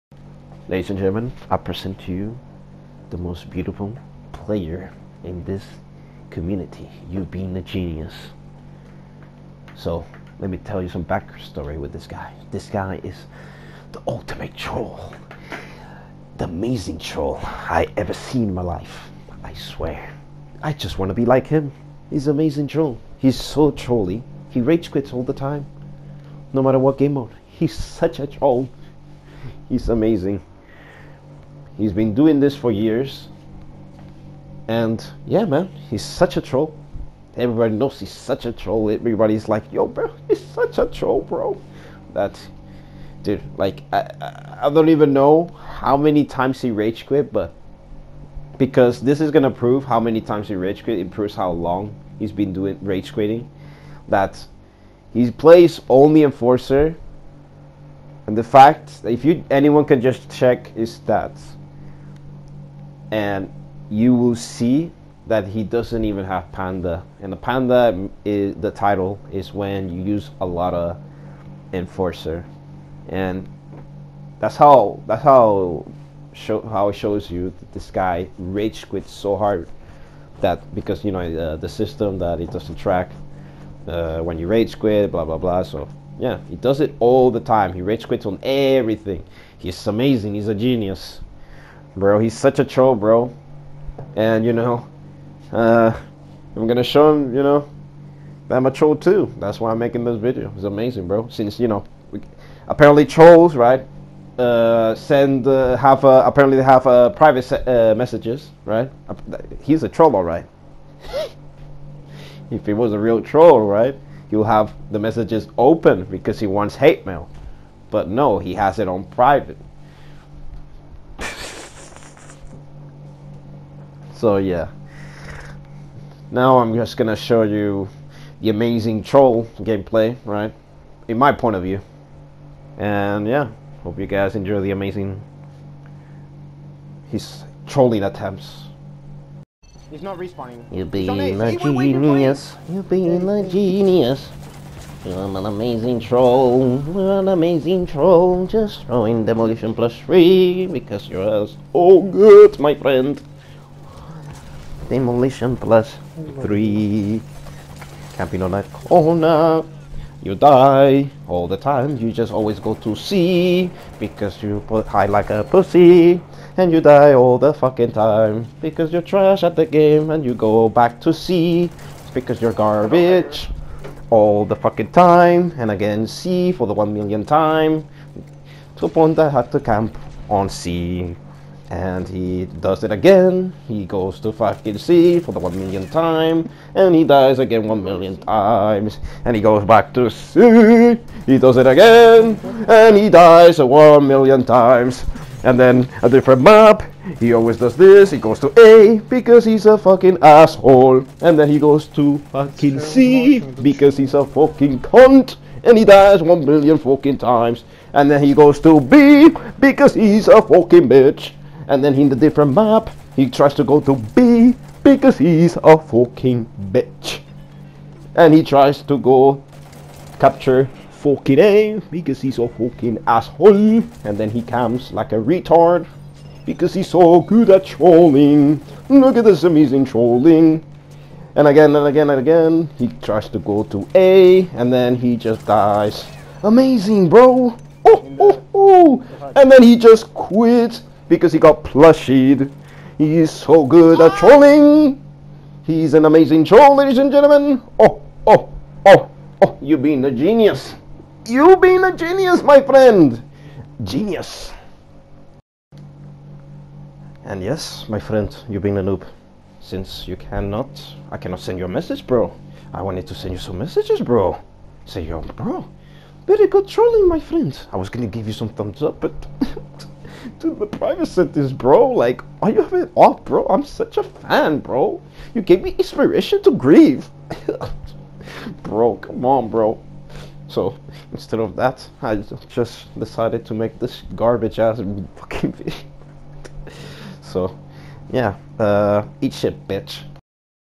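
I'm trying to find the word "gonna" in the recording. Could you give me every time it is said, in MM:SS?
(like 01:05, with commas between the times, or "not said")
00:49, 01:36, 02:06, 04:27.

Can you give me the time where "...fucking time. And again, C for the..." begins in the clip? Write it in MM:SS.
02:54.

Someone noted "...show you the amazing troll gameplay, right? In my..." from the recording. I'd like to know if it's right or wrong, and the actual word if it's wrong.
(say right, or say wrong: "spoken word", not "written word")
right.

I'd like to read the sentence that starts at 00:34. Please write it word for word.
And yeah, man, he's such a troll.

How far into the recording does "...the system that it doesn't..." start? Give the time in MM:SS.
01:21.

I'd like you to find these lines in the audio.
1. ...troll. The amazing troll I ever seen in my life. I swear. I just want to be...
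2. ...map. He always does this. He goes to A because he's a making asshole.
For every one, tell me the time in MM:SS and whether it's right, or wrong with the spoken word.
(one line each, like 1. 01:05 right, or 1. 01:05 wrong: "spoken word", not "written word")
1. 00:14 right
2. 03:16 wrong: "fucking", not "making".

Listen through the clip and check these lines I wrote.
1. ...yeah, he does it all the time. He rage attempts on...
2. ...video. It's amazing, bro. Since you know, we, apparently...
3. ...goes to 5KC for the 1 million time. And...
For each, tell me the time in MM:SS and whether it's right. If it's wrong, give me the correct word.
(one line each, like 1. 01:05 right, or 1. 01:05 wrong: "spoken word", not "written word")
1. 01:26 wrong: "quits", not "attempts"
2. 01:40 right
3. 03:03 right.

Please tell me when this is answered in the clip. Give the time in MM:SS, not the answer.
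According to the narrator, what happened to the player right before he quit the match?
04:01.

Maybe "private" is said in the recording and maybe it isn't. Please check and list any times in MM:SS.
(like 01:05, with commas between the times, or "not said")
01:47, 01:59, 04:30.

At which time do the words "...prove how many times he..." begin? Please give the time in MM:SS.
00:49.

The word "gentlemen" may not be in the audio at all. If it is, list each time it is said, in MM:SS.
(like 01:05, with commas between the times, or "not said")
00:00, 04:07.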